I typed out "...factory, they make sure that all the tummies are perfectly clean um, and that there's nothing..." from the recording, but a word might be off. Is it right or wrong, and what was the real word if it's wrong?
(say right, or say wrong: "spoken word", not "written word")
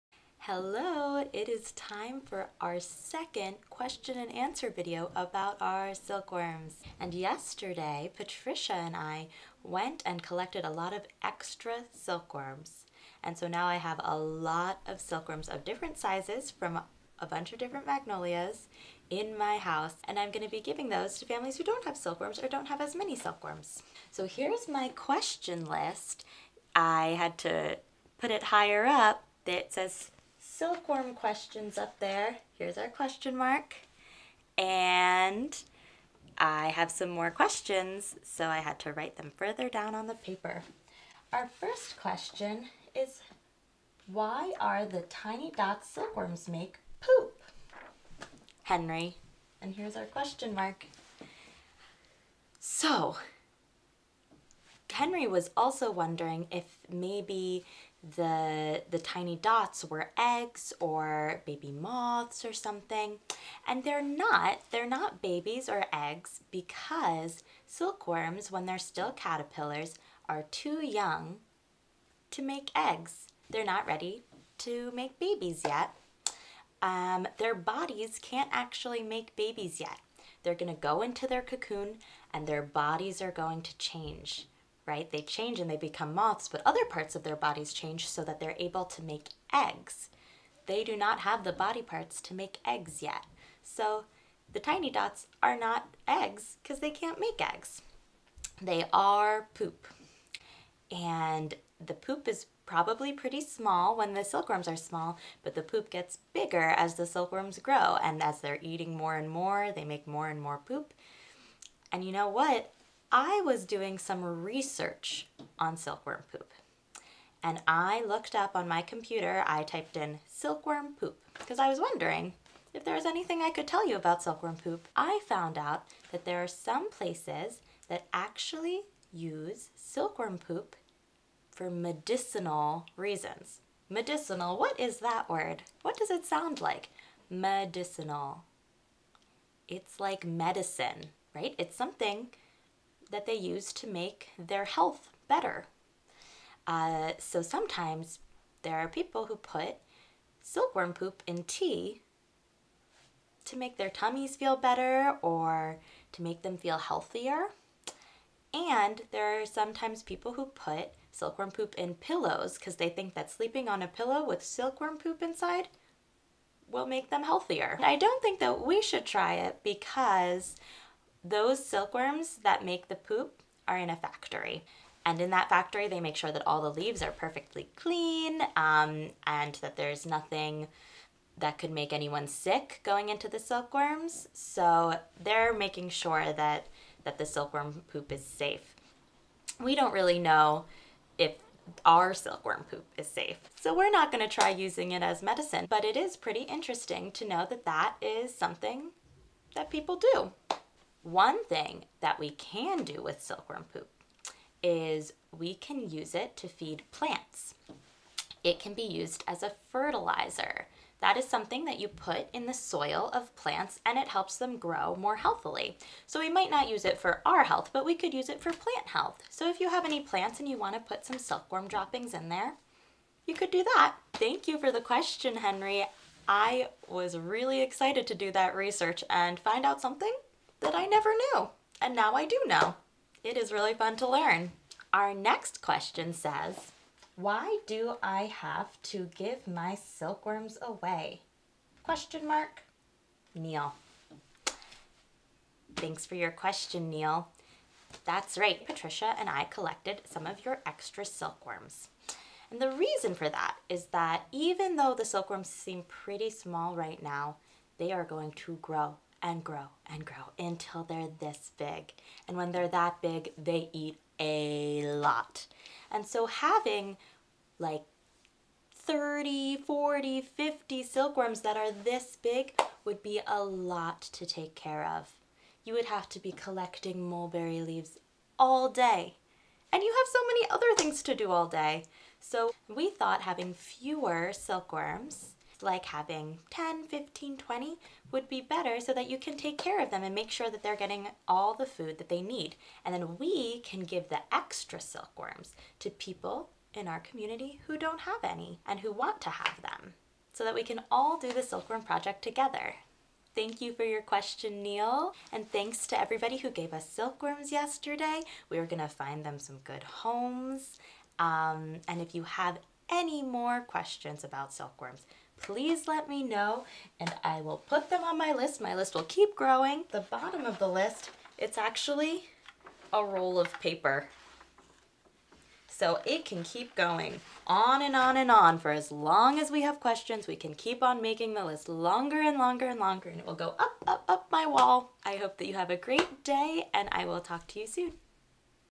wrong: "leaves", not "tummies".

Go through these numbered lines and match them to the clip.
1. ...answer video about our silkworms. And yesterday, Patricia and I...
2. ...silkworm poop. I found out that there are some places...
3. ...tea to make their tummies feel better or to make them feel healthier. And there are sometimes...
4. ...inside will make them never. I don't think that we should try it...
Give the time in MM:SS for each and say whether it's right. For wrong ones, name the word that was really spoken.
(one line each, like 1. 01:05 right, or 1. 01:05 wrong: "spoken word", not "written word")
1. 00:04 right
2. 02:04 right
3. 02:31 right
4. 02:45 wrong: "healthier", not "never".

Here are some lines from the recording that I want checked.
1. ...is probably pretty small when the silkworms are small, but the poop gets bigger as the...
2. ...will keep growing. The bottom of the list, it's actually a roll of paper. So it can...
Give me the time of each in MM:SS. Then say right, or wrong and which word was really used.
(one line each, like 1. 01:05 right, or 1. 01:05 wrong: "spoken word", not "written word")
1. 01:42 right
2. 05:18 right.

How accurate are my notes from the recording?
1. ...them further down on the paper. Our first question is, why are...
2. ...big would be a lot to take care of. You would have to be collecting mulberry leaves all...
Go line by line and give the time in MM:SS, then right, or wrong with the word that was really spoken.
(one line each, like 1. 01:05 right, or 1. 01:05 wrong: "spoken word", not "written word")
1. 00:39 right
2. 04:32 right.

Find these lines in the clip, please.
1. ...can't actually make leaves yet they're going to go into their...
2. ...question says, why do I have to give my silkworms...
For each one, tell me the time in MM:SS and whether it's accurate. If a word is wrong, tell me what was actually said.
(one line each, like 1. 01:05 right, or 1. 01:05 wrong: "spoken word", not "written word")
1. 01:18 wrong: "babies", not "leaves"
2. 03:55 right.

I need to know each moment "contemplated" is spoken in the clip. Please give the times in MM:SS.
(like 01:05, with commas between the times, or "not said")
not said.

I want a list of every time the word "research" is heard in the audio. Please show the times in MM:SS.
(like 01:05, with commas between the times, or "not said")
01:54, 03:48.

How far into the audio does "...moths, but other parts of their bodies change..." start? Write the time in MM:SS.
01:26.